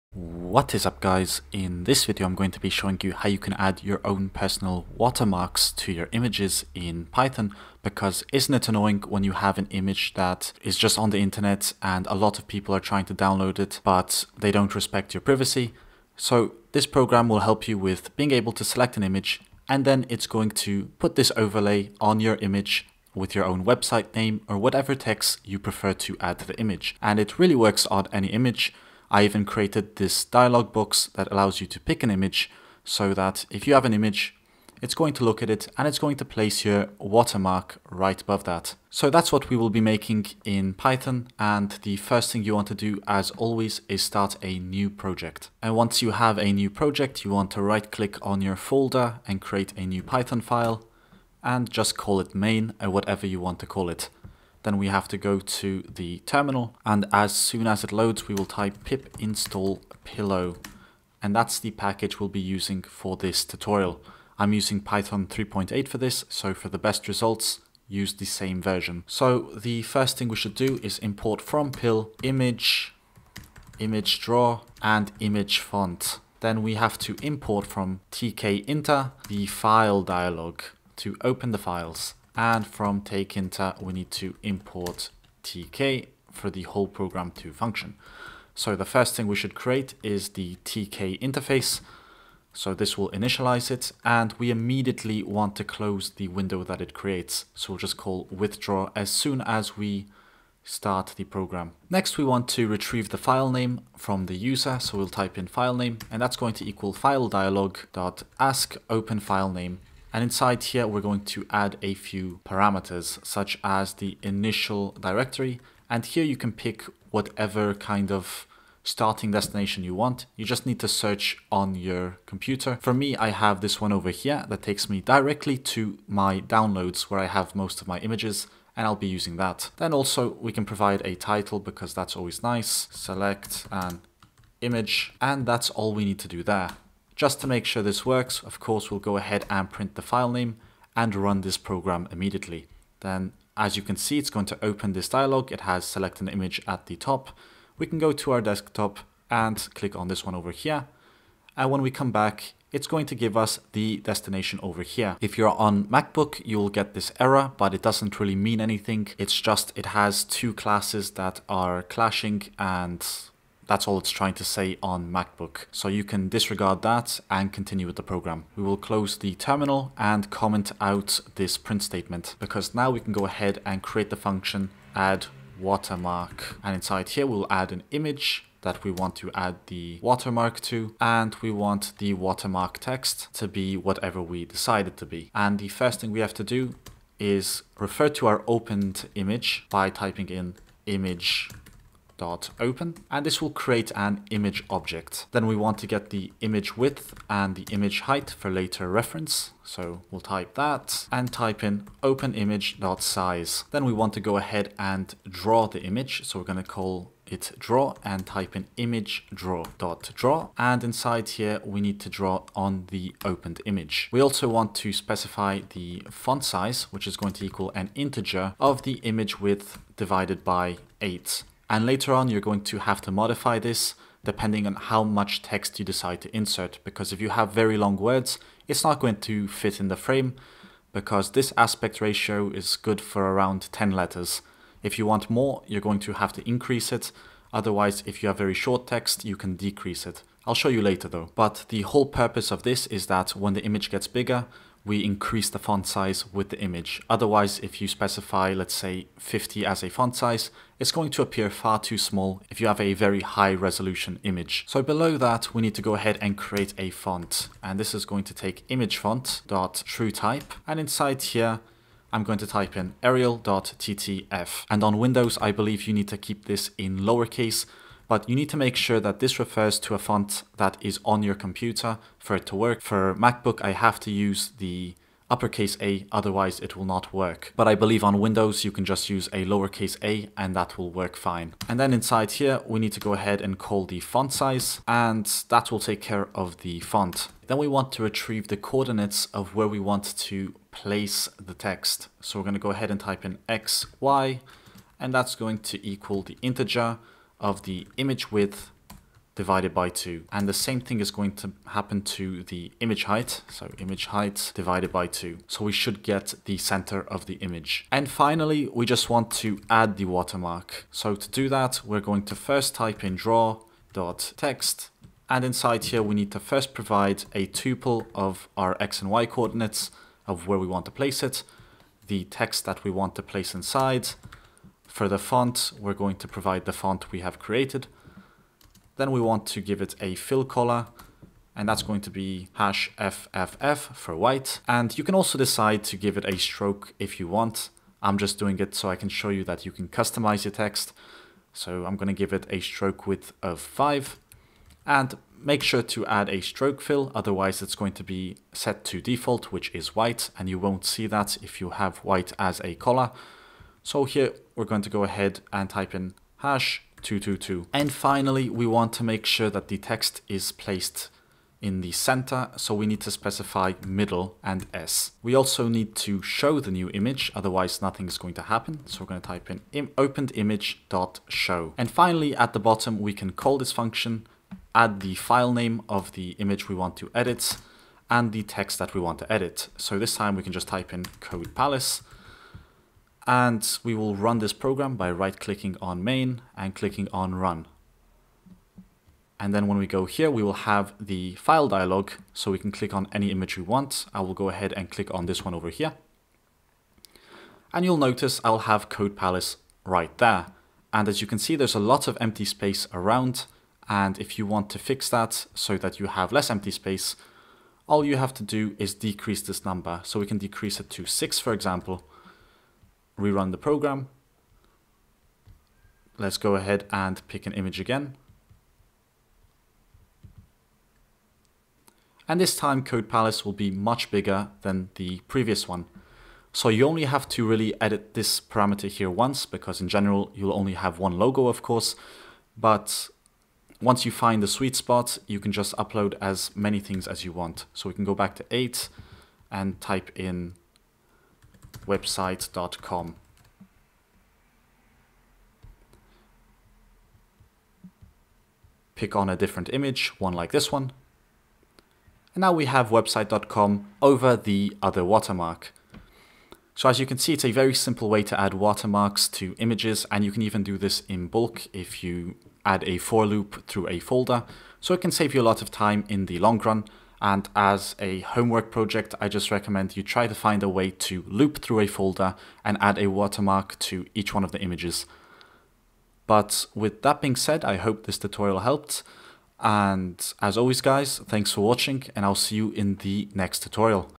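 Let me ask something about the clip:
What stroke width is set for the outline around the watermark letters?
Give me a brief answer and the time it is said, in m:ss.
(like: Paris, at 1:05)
5, at 5:43.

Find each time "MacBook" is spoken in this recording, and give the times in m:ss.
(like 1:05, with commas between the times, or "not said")
2:35, 2:45, 4:33.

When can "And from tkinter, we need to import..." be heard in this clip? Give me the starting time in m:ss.
1:22.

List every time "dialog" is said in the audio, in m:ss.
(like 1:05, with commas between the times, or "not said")
0:30, 1:20, 1:47, 2:25, 6:31.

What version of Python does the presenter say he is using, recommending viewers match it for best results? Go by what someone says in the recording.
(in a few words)
3.8.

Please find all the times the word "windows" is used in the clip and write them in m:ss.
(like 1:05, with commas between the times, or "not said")
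1:36, 4:24, 4:38.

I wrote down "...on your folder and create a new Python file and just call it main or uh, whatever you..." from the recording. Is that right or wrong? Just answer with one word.
right.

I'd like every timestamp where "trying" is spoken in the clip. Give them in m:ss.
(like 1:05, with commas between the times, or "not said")
0:12, 2:44.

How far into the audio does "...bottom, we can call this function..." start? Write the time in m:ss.
6:12.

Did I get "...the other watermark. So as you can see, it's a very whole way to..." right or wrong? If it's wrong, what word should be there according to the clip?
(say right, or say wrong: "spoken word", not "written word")
wrong: "simple", not "whole".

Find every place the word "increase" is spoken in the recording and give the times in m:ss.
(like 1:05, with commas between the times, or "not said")
3:56, 4:05.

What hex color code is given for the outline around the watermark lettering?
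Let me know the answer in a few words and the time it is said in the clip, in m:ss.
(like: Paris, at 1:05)
#222, at 5:56.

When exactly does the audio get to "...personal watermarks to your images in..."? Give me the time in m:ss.
0:04.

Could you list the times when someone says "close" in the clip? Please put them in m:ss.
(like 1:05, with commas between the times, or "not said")
1:35, 2:48.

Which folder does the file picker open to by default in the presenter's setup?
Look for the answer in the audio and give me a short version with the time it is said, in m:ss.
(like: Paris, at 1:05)
downloads, at 2:06.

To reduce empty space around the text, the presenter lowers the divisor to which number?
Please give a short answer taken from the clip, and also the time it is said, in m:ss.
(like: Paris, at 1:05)
6, at 6:51.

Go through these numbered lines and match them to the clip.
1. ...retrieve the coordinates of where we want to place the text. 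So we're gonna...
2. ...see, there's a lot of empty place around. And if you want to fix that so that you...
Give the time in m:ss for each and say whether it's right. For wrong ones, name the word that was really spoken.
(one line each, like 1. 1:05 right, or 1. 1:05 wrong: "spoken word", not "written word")
1. 4:48 right
2. 6:41 wrong: "space", not "place".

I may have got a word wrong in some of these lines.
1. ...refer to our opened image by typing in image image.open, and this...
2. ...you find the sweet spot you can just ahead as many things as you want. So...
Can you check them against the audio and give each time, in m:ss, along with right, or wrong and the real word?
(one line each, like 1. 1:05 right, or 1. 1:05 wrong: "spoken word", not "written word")
1. 3:07 right
2. 7:14 wrong: "upload", not "ahead".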